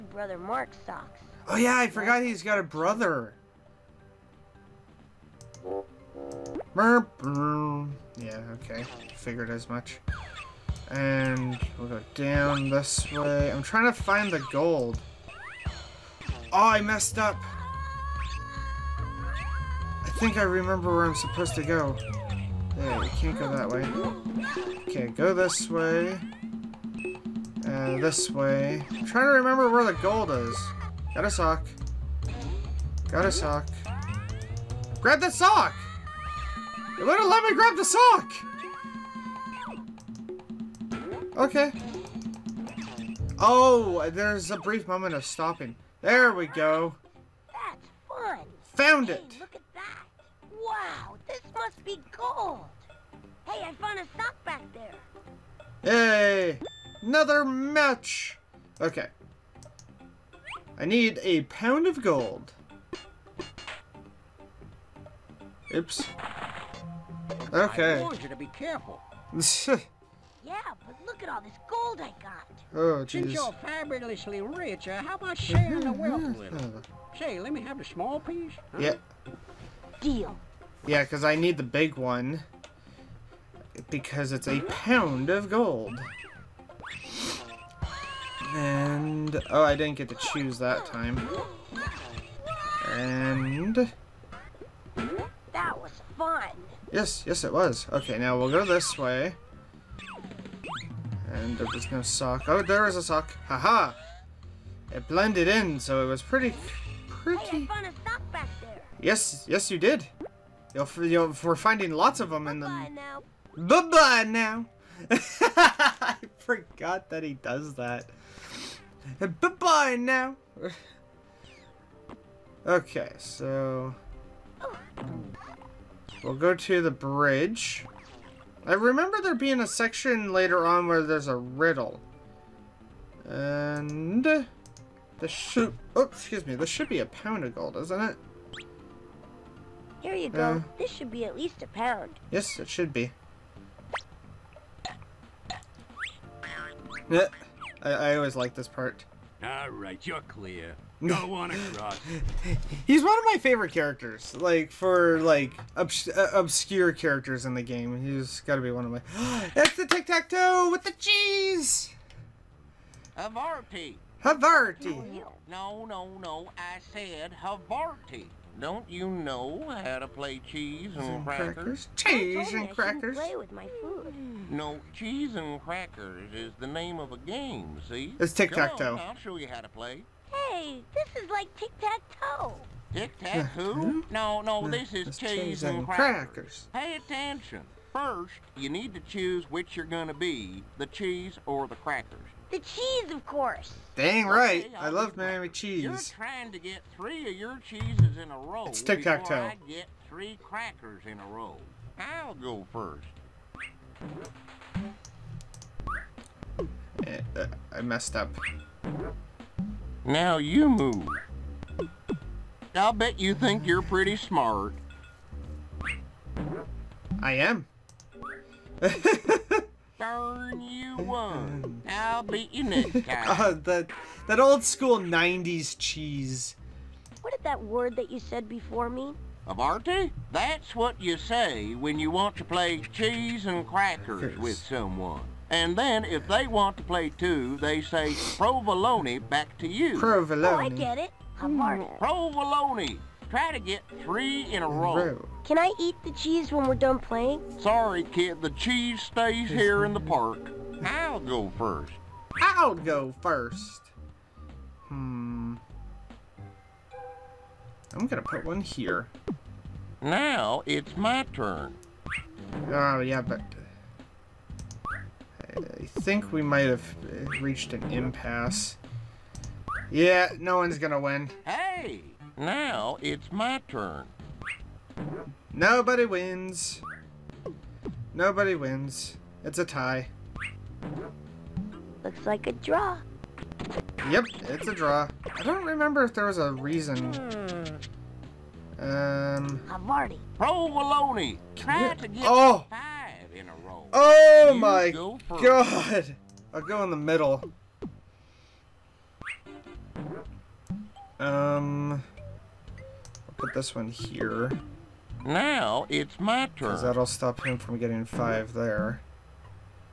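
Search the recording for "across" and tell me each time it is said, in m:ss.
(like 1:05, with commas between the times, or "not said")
2:31.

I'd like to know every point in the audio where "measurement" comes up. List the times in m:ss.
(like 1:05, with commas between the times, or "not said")
not said.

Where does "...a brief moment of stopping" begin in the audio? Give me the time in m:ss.
0:44.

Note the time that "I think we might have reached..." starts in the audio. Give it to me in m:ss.
4:24.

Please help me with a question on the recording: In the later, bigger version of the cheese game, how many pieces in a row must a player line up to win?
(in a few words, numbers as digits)
5.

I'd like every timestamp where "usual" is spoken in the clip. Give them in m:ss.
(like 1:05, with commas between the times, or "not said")
not said.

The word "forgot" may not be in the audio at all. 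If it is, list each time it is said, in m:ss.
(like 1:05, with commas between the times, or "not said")
0:01, 1:56.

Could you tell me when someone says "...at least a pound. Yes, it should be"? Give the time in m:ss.
2:21.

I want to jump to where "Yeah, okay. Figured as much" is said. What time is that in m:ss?
0:08.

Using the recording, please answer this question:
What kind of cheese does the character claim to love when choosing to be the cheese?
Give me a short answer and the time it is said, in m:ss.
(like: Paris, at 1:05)
Miami cheese, at 3:15.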